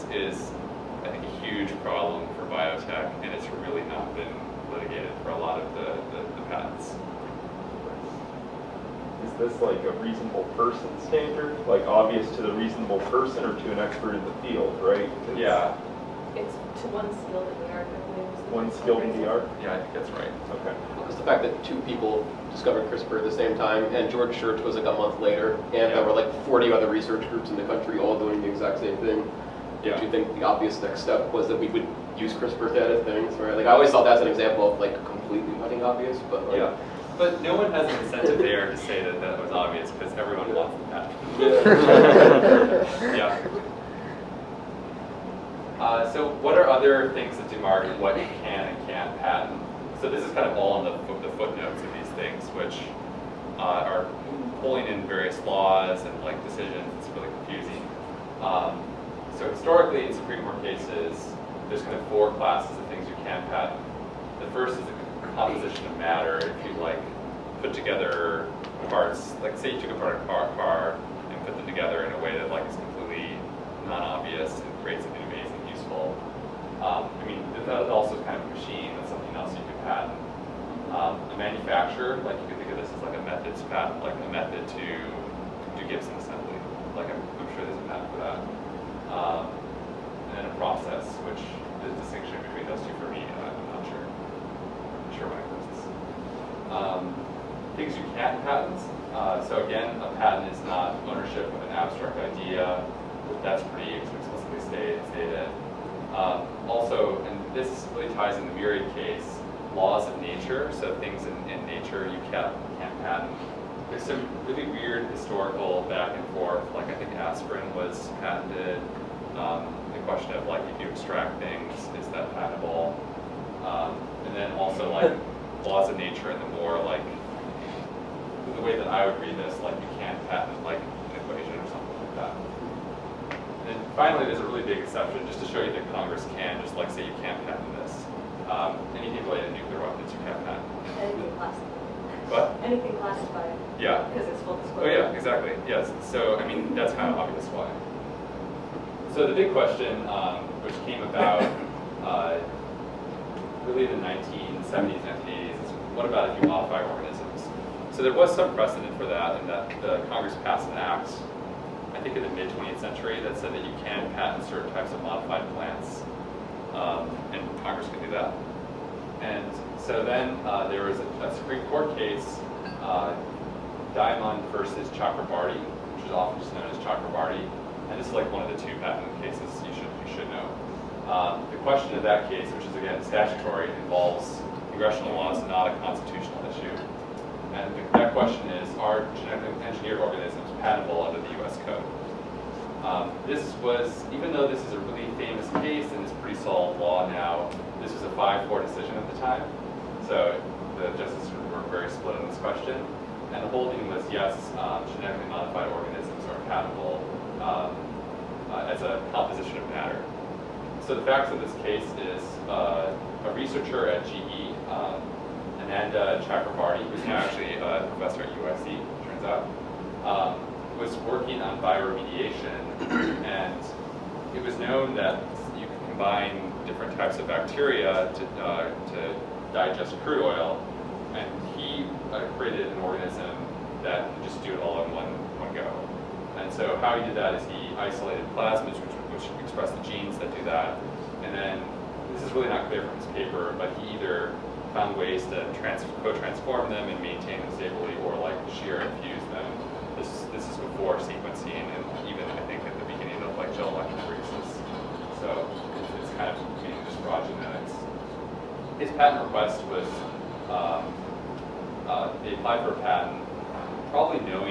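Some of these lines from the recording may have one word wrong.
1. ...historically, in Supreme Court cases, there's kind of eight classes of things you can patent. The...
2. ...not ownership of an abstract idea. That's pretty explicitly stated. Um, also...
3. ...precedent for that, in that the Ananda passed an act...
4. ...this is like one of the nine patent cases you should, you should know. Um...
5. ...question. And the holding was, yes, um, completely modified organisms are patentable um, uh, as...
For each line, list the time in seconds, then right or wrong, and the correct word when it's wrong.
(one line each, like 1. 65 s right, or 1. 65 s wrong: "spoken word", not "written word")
1. 59 s wrong: "four", not "eight"
2. 100 s right
3. 158 s wrong: "Congress", not "Ananda"
4. 177 s wrong: "two", not "nine"
5. 202 s wrong: "genetically", not "completely".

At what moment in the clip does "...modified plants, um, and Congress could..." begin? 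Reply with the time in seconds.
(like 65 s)
165 s.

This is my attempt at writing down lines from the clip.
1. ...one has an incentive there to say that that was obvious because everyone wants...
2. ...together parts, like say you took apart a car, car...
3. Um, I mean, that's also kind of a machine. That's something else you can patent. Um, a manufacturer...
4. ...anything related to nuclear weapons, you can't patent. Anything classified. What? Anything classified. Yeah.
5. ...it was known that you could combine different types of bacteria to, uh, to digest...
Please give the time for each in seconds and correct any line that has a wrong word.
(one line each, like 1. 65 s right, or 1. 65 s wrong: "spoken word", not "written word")
1. 37 s right
2. 67 s right
3. 76 s right
4. 138 s right
5. 224 s right.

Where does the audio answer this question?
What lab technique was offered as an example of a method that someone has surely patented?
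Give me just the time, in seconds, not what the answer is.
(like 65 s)
85 s.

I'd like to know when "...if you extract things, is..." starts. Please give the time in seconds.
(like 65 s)
120 s.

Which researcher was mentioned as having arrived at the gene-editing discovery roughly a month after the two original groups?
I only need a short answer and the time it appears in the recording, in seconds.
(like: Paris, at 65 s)
George Church, at 24 s.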